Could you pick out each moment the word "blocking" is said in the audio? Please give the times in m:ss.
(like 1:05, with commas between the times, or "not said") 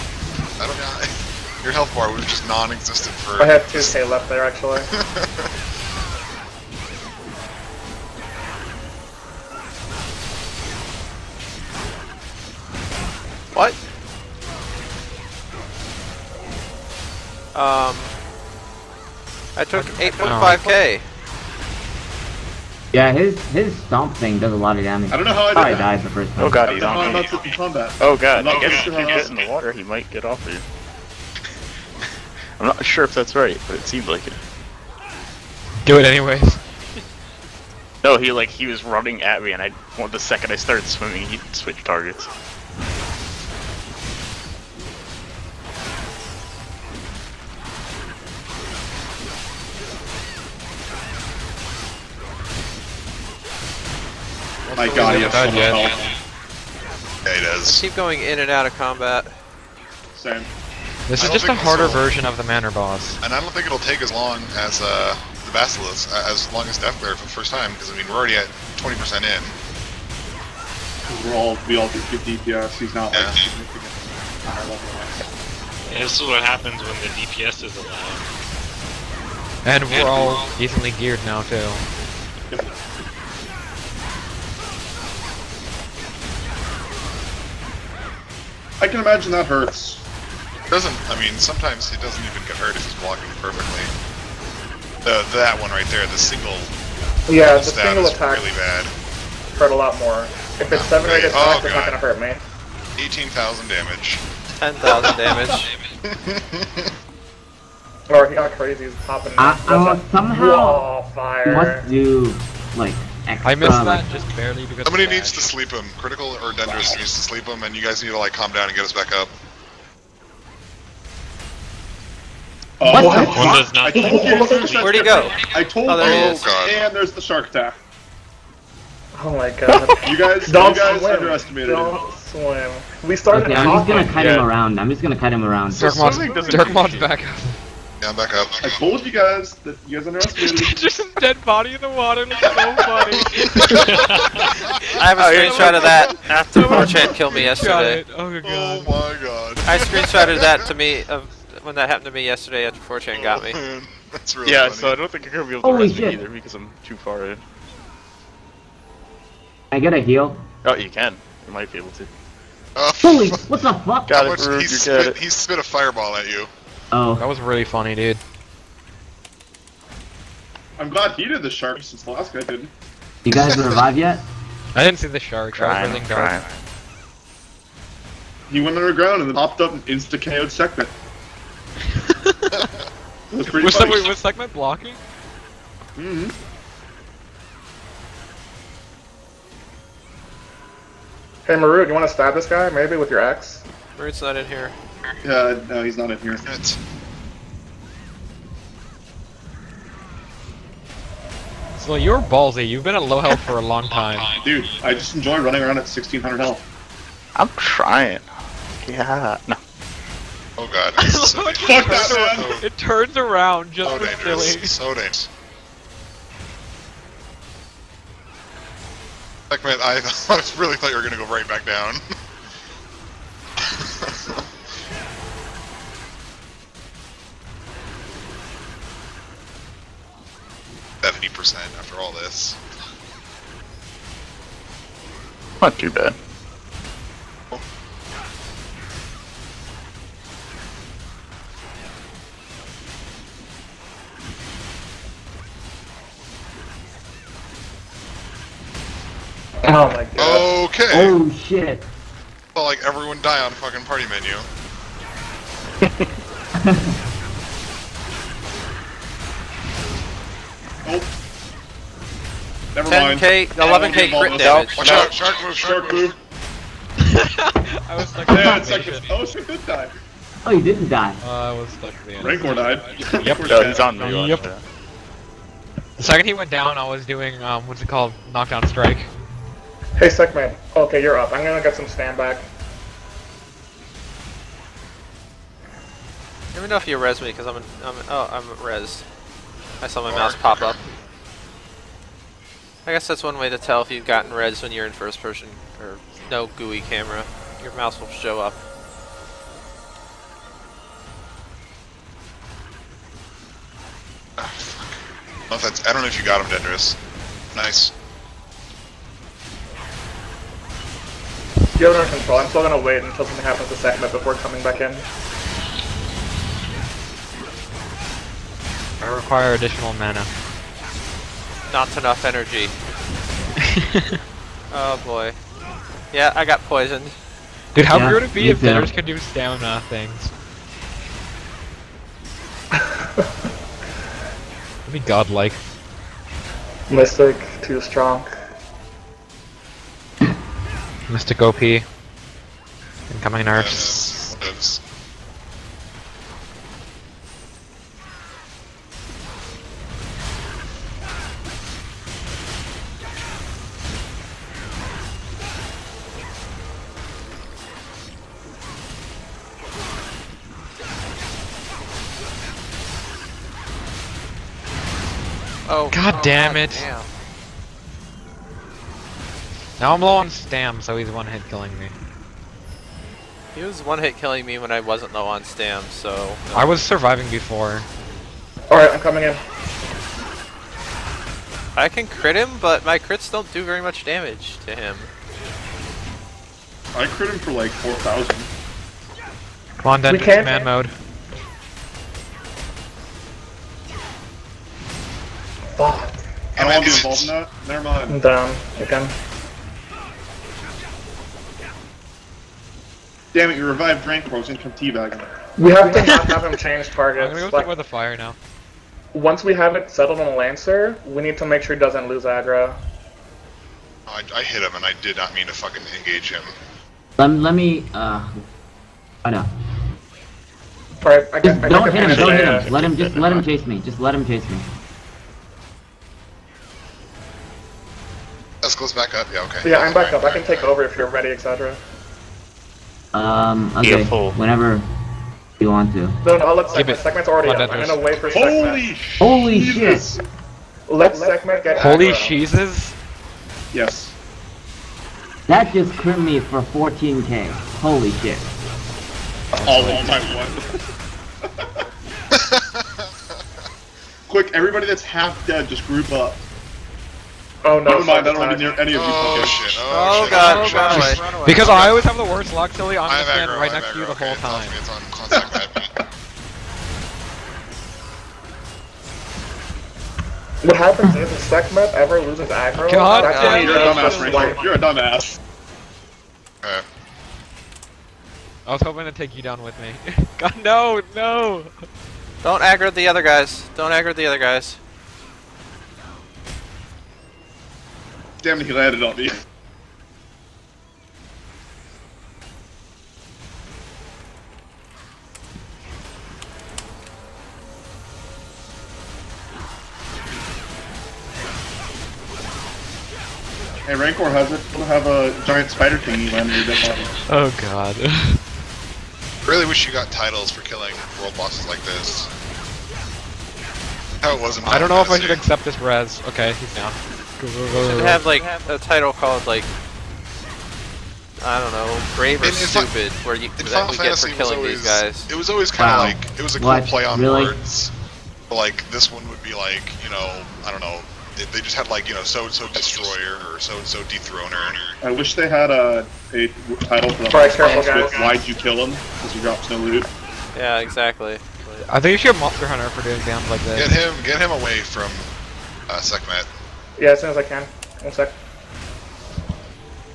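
1:33, 3:04.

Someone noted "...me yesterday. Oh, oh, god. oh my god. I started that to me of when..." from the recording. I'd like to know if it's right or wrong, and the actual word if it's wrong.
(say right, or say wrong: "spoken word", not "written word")
wrong: "screenshotted", not "started".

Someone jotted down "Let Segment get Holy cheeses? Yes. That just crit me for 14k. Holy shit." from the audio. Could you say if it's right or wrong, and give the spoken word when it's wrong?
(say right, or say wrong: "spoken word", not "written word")
right.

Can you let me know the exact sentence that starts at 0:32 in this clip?
I'm not sure if that's right, but it seemed like it.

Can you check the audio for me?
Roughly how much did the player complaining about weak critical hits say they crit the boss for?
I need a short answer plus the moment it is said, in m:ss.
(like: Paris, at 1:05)
4,000, at 6:27.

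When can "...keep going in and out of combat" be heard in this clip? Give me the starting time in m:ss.
0:57.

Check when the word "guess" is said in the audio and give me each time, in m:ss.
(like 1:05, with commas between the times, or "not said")
0:28, 4:52.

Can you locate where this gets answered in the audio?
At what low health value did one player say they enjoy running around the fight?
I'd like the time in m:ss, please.
3:25.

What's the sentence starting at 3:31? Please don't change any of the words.
So it, turns around, it turns around just so dangerous.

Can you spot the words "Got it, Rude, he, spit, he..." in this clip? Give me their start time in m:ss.
2:44.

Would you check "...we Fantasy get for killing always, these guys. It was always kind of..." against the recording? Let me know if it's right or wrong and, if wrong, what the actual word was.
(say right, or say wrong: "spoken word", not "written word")
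right.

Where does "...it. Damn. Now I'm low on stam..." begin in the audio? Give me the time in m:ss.
6:06.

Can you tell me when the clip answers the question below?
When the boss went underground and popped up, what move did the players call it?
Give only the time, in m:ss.
2:07.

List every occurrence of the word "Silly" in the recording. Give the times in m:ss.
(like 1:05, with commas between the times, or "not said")
3:34, 7:42.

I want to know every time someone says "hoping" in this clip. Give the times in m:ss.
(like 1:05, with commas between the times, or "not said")
7:58.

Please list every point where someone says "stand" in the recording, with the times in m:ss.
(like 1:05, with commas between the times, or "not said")
4:41, 7:43.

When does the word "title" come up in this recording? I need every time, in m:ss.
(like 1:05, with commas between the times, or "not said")
8:30, 8:38, 8:56.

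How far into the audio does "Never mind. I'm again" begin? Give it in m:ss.
6:37.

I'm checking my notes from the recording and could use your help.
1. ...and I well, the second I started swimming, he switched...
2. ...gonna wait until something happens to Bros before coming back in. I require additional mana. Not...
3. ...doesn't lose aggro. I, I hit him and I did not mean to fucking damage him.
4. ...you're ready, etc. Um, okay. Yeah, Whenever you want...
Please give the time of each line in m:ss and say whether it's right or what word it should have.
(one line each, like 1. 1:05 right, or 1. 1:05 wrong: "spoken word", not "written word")
1. 0:39 right
2. 5:12 wrong: "Sackmet", not "Bros"
3. 6:51 wrong: "engage", not "damage"
4. 7:10 right.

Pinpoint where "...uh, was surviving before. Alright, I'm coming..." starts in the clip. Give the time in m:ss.
6:16.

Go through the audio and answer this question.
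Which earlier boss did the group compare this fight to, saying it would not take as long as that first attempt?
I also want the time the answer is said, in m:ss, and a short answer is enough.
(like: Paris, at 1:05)
Deathglare, at 1:06.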